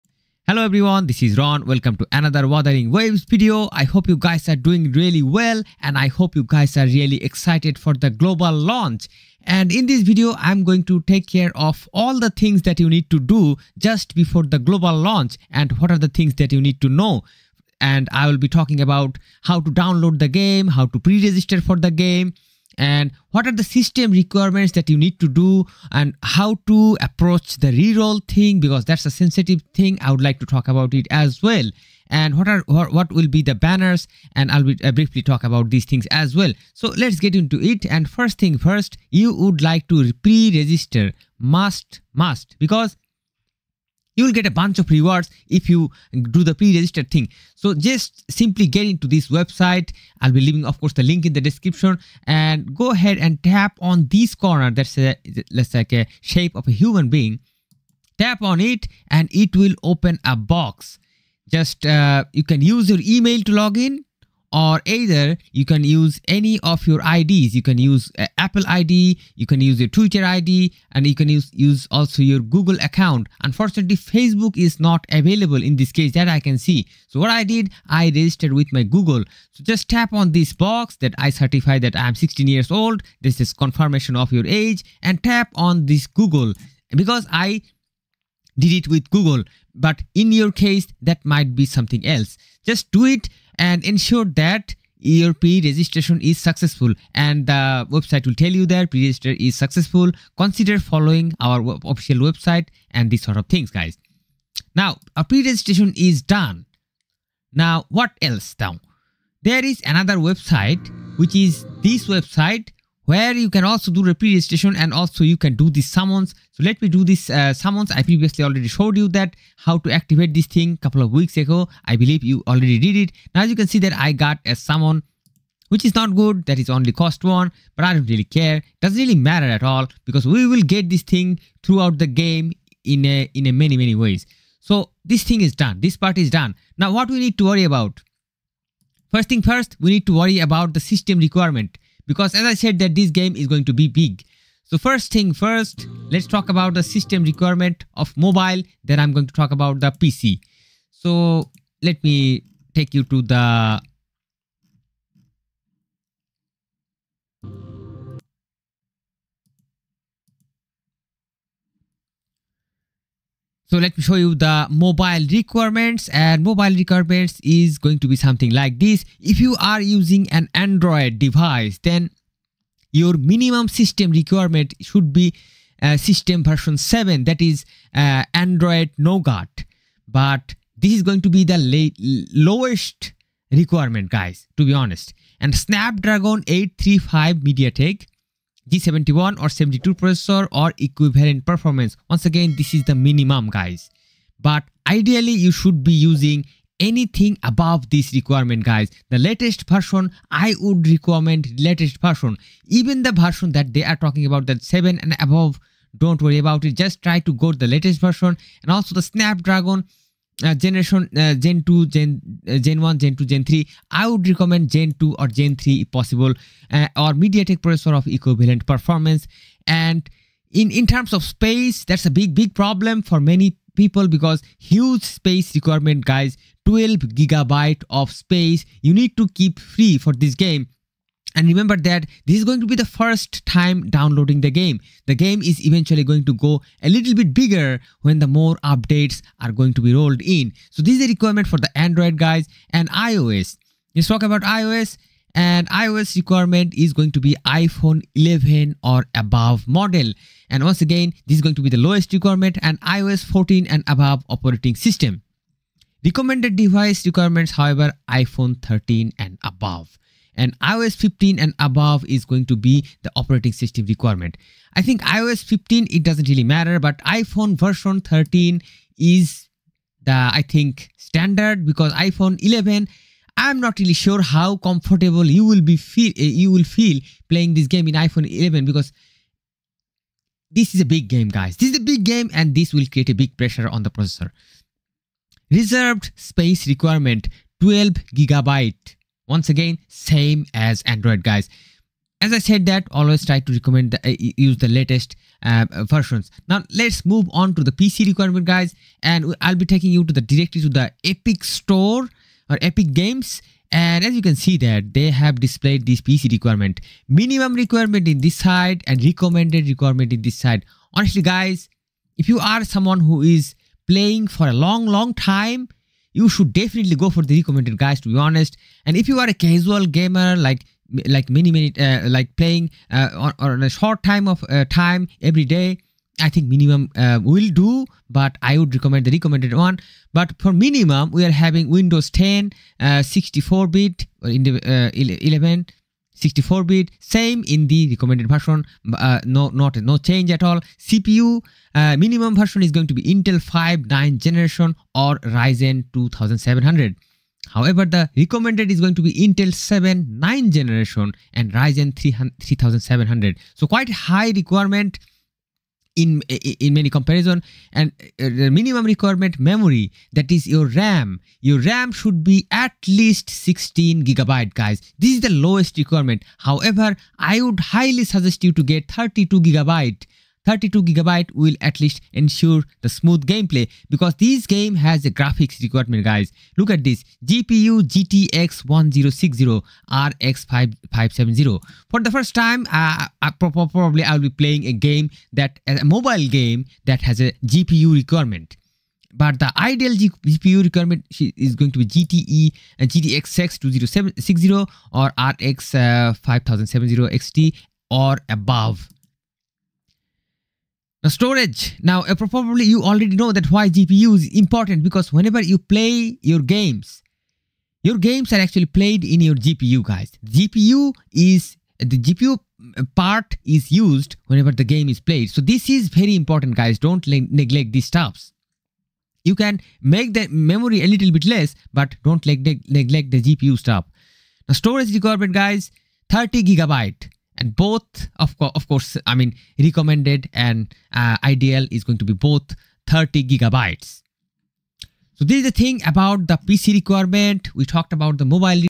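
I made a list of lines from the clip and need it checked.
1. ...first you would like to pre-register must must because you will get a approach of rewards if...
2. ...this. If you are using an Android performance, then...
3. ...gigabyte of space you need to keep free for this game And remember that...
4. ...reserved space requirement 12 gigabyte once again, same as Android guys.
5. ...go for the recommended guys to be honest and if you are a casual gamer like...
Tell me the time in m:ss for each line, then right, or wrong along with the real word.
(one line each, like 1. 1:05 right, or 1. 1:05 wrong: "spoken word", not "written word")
1. 0:38 wrong: "bunch", not "approach"
2. 2:48 wrong: "device", not "performance"
3. 3:47 right
4. 4:45 right
5. 5:16 right.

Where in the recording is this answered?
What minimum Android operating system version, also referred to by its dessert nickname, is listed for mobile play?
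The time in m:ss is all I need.
2:58.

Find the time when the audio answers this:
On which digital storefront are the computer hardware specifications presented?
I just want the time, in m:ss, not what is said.
5:02.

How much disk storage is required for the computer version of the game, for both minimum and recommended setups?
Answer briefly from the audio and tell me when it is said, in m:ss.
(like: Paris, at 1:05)
30 GB, at 7:06.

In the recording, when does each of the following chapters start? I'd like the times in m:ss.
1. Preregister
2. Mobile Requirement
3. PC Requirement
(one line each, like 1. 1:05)
1. 0:40
2. 2:43
3. 4:57.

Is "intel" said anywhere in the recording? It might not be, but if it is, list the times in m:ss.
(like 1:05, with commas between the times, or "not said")
5:43, 5:49.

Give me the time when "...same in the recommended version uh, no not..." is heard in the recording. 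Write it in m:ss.
5:37.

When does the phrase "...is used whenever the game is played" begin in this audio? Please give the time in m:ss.
6:53.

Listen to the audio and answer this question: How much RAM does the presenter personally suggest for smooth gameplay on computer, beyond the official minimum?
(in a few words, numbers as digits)
32 GB.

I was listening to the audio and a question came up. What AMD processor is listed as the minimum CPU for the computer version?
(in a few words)
Ryzen 2700.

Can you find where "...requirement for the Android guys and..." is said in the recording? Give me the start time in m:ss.
4:01.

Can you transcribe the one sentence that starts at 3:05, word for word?
And Snapdragon 835 MediaTek G71 or 72 processor or equivalent performance.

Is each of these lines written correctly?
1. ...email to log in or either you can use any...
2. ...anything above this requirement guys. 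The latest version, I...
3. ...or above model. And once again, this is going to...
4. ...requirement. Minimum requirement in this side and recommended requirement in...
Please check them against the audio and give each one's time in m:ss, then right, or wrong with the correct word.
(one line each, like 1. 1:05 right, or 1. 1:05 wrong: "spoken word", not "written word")
1. 1:03 right
2. 3:16 right
3. 4:08 right
4. 5:06 right.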